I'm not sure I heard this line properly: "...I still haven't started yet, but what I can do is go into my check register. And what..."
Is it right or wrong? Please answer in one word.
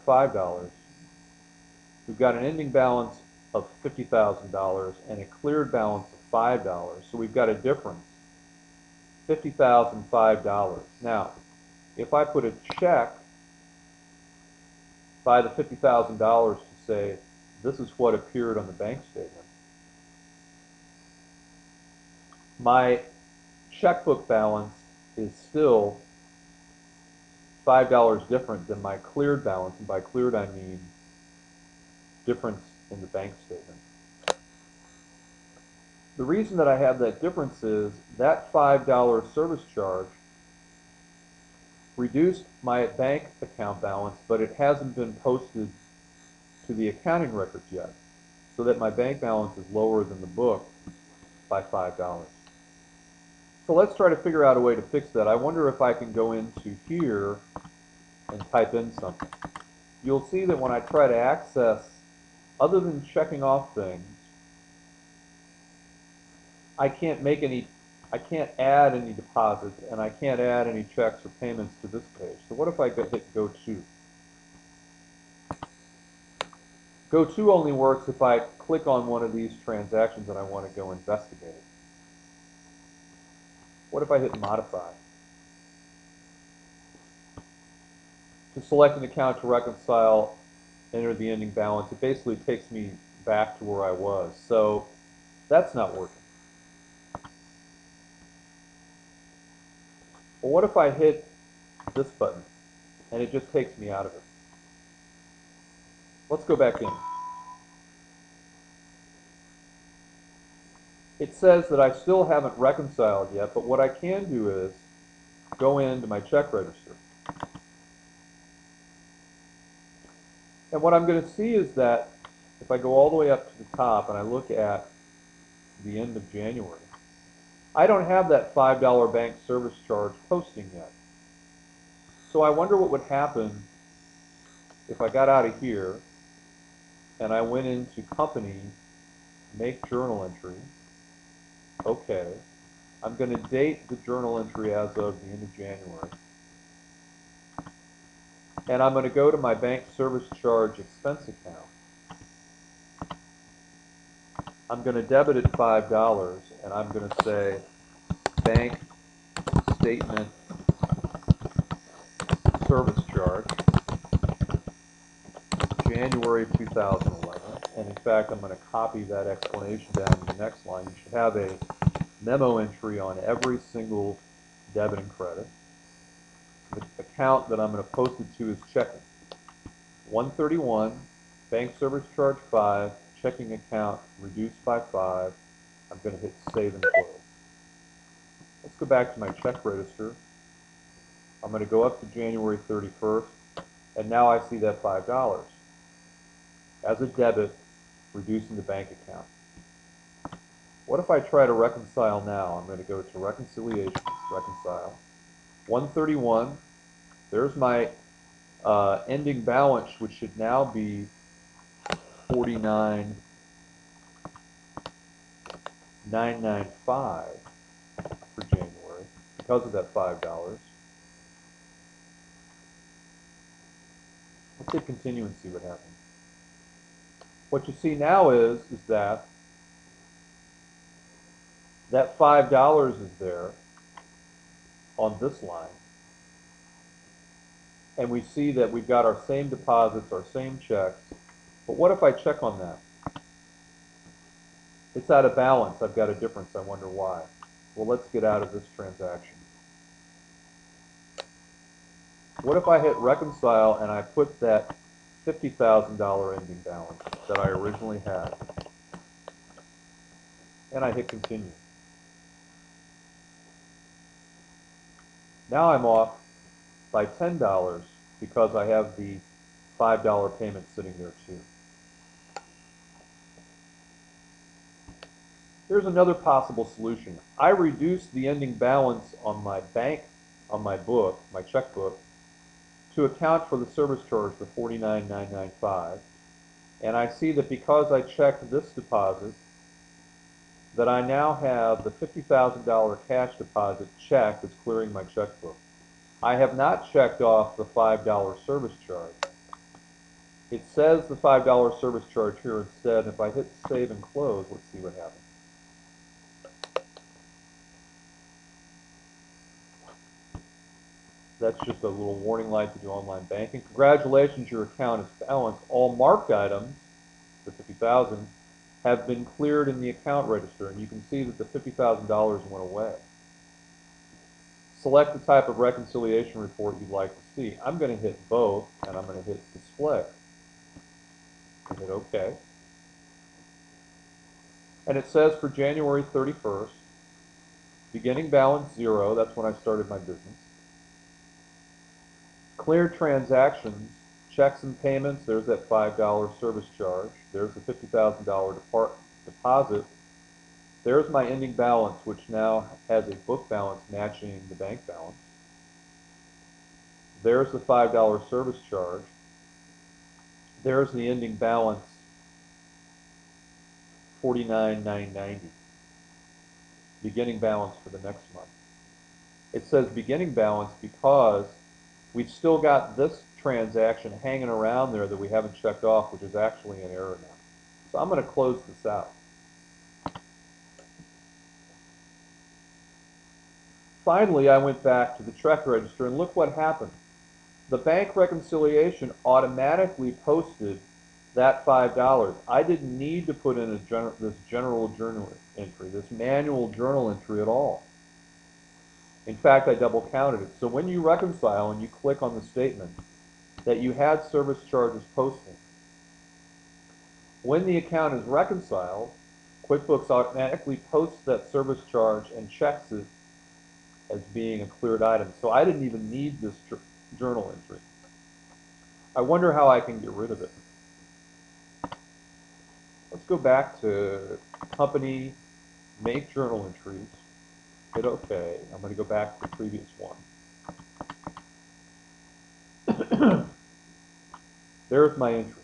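wrong.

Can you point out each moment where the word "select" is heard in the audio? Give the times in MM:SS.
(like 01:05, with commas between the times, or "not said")
01:28, 05:24.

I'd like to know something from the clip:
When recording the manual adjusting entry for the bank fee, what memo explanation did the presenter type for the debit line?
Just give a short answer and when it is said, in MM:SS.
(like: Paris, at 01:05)
bank statement service charge, January 2011, at 02:38.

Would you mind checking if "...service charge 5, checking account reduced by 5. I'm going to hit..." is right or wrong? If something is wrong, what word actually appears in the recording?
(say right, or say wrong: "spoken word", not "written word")
right.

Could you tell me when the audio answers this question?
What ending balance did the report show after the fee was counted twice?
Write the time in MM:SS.
06:04.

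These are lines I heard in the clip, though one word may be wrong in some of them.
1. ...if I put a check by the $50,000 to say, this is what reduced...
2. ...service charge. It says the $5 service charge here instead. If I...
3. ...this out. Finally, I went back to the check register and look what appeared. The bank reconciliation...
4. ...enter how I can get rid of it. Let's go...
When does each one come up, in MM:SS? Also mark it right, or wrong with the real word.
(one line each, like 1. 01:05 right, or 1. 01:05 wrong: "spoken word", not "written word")
1. 00:11 wrong: "appeared", not "reduced"
2. 04:58 right
3. 06:18 wrong: "happened", not "appeared"
4. 06:59 wrong: "wonder", not "enter".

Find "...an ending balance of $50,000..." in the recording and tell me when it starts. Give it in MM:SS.
00:02.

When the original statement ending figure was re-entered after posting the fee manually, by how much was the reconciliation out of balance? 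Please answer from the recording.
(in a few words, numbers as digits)
$10.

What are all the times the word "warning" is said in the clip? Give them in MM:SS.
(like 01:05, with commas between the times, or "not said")
05:12.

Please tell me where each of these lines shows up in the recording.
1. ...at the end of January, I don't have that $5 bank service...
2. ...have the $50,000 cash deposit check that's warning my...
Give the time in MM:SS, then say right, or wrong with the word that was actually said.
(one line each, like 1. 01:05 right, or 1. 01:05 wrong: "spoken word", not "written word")
1. 02:04 right
2. 04:51 wrong: "clearing", not "warning".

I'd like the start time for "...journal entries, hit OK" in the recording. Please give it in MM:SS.
07:06.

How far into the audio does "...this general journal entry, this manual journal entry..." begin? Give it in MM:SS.
06:34.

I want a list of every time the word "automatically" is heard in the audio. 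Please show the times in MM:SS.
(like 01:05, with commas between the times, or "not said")
06:29, 06:50.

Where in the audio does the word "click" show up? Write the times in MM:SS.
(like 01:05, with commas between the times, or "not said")
01:18, 06:41.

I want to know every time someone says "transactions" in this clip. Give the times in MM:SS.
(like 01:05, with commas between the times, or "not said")
01:19, 04:08, 05:42, 06:13.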